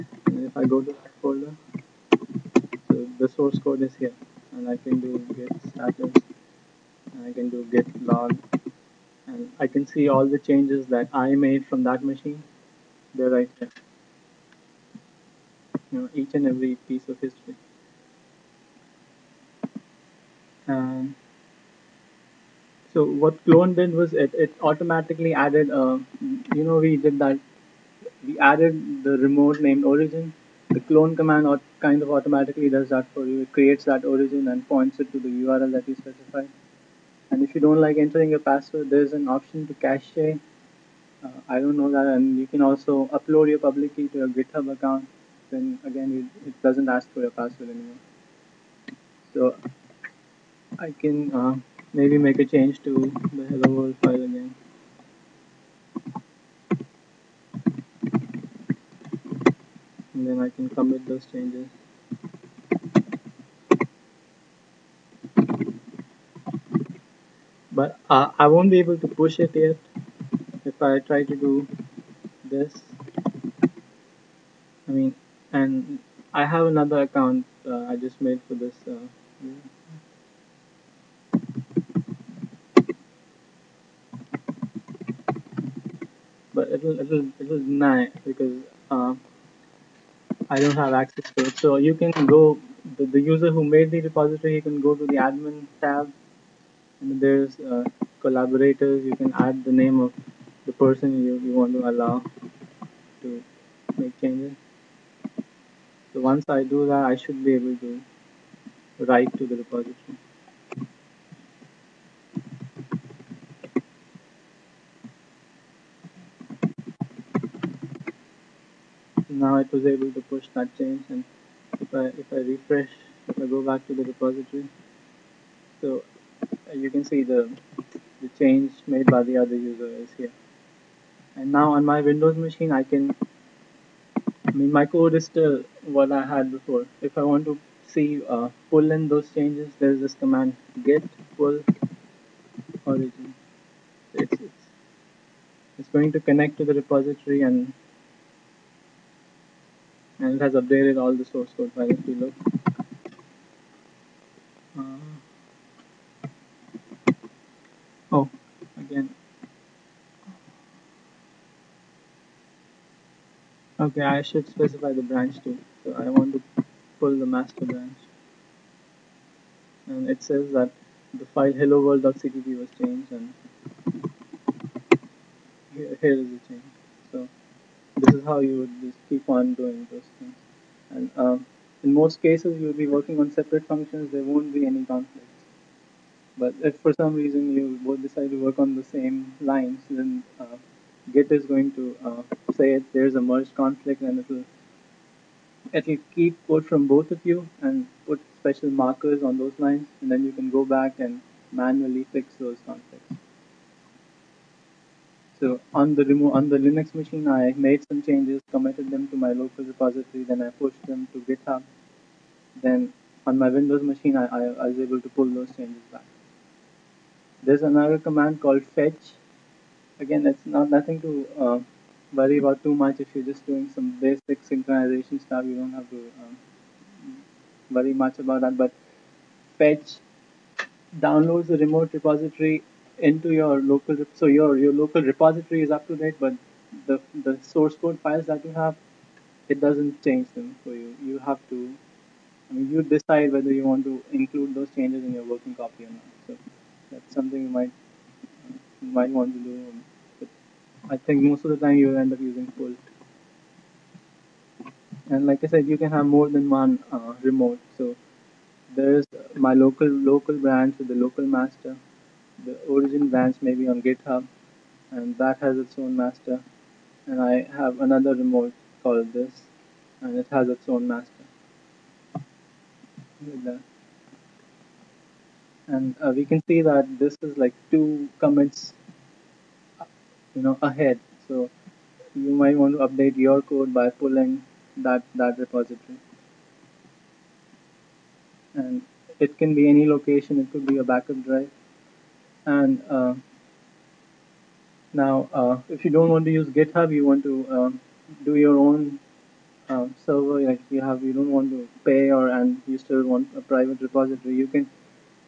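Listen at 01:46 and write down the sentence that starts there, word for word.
So once I do that, I should be able to write to the repository.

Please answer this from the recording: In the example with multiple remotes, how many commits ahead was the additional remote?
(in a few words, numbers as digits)
2.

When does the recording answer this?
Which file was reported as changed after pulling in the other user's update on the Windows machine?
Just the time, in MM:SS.
02:51.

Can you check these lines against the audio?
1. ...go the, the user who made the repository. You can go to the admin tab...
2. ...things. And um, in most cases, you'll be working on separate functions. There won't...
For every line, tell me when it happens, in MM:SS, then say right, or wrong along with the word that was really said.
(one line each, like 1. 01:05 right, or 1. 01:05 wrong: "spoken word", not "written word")
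1. 01:32 right
2. 03:00 right.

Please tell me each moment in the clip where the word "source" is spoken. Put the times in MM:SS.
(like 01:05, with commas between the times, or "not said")
00:03, 02:31, 03:57.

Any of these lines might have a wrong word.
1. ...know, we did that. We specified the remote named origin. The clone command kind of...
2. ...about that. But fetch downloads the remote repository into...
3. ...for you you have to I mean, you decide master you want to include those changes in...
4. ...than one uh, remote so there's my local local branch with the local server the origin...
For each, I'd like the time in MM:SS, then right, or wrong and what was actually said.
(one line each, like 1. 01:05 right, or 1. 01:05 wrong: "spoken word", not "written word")
1. 00:26 wrong: "added", not "specified"
2. 03:48 right
3. 04:00 wrong: "whether", not "master"
4. 04:16 wrong: "master", not "server".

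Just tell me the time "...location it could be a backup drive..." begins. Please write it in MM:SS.
04:49.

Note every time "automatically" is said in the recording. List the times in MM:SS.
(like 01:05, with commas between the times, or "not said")
00:24, 00:32.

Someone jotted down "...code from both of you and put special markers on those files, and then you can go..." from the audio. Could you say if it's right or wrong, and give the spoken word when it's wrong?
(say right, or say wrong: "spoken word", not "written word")
wrong: "lines", not "files".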